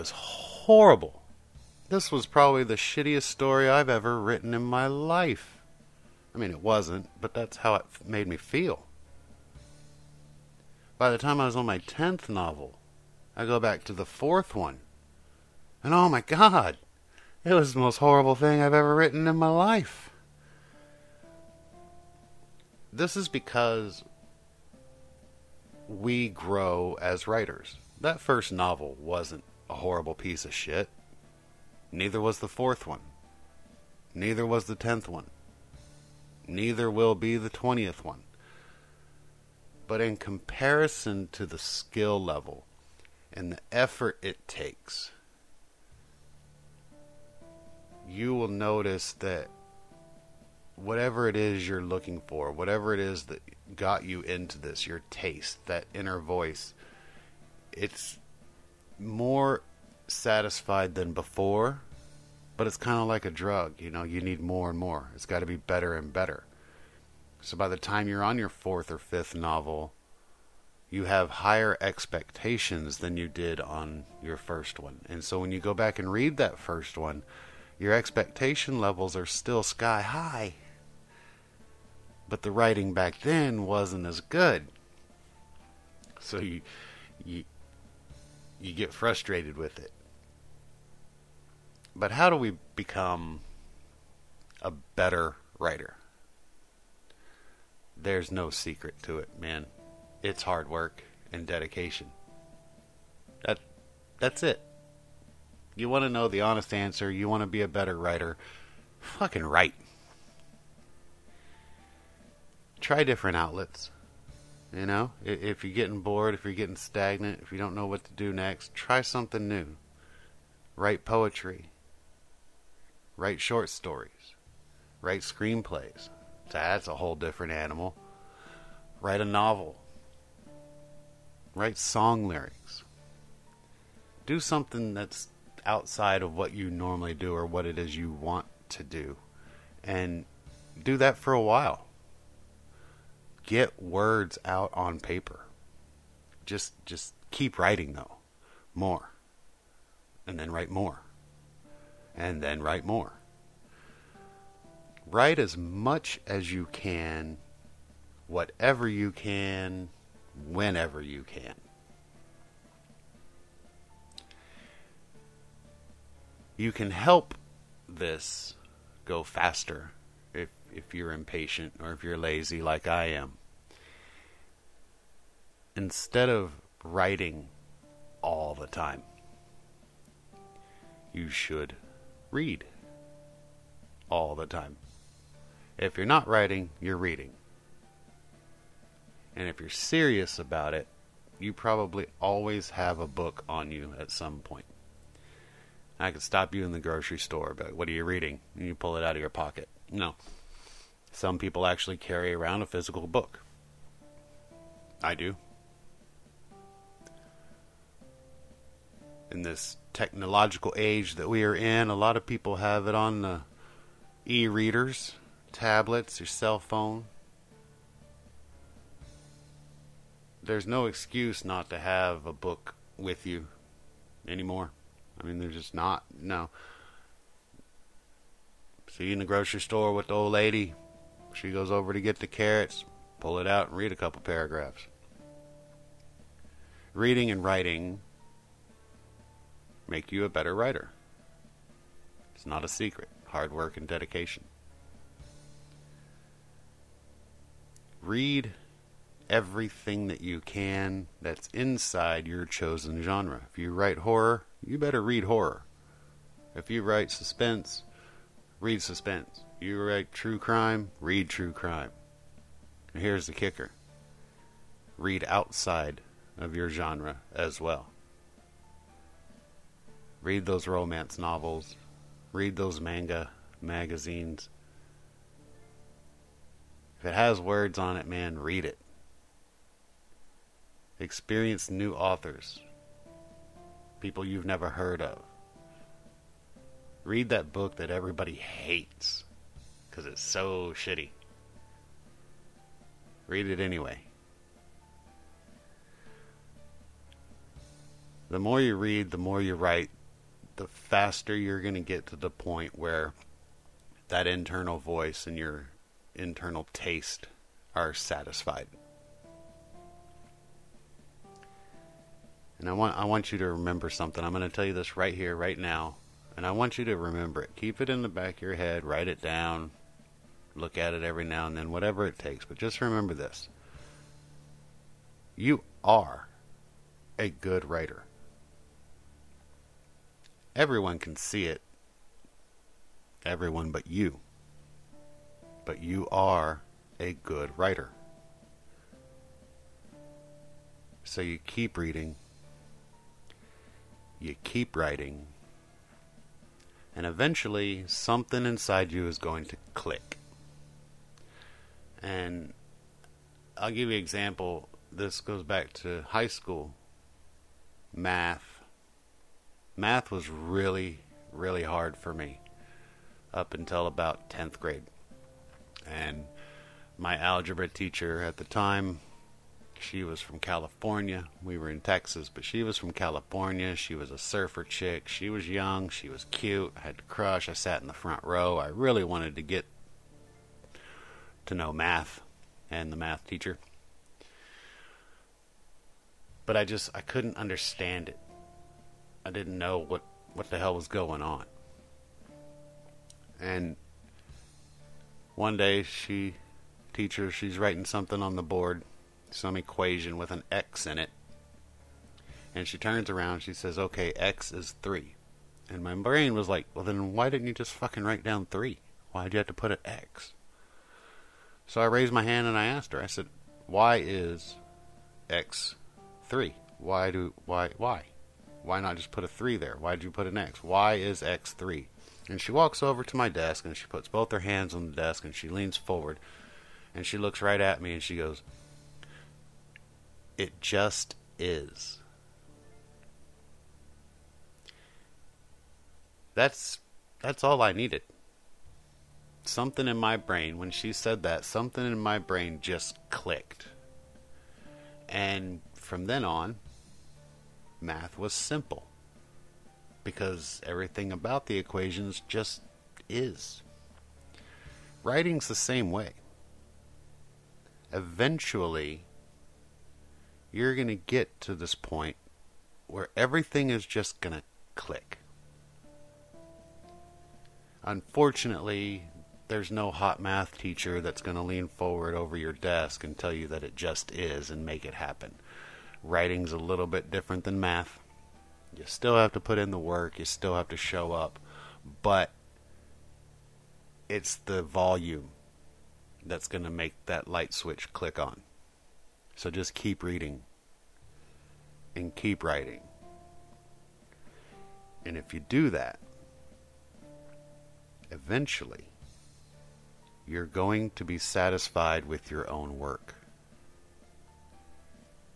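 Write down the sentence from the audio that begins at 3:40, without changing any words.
There's no excuse not to have a book with you anymore.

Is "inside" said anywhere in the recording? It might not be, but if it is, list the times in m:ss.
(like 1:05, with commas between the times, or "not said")
4:11, 5:48.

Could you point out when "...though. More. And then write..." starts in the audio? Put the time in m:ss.
2:27.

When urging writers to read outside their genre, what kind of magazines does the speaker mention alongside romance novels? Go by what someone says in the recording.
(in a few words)
Manga magazines.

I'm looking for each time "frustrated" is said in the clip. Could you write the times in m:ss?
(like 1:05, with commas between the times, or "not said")
1:28.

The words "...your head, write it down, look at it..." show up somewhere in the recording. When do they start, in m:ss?
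5:18.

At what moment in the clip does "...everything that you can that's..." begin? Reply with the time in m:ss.
4:09.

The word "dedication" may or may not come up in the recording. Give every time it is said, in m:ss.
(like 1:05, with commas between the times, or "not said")
1:41, 4:03.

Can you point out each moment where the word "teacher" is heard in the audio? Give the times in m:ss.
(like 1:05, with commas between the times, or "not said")
6:07, 6:23, 6:36, 7:50.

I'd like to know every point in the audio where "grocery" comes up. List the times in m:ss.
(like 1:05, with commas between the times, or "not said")
3:16, 3:49.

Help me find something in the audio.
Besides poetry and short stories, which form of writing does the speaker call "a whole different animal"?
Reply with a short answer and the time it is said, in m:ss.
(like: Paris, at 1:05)
Screenplays, at 2:05.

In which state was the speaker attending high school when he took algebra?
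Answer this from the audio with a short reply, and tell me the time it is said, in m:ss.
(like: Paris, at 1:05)
Texas, at 6:11.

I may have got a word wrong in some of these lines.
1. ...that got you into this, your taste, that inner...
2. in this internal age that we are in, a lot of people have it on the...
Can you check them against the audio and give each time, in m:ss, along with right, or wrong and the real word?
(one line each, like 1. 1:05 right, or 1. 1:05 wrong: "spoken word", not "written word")
1. 0:53 right
2. 3:29 wrong: "technological", not "internal".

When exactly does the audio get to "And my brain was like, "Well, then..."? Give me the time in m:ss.
6:45.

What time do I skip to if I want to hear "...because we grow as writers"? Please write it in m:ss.
0:23.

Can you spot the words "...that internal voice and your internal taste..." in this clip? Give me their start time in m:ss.
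5:04.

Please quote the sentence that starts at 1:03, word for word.
You know, you need more and more.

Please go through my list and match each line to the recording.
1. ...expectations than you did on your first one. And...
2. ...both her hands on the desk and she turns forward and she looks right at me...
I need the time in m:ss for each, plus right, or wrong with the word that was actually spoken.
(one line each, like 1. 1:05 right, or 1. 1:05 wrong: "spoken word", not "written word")
1. 1:11 right
2. 7:04 wrong: "leans", not "turns".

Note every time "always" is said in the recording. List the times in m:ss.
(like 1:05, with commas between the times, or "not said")
3:12.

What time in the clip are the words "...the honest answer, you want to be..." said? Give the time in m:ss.
1:46.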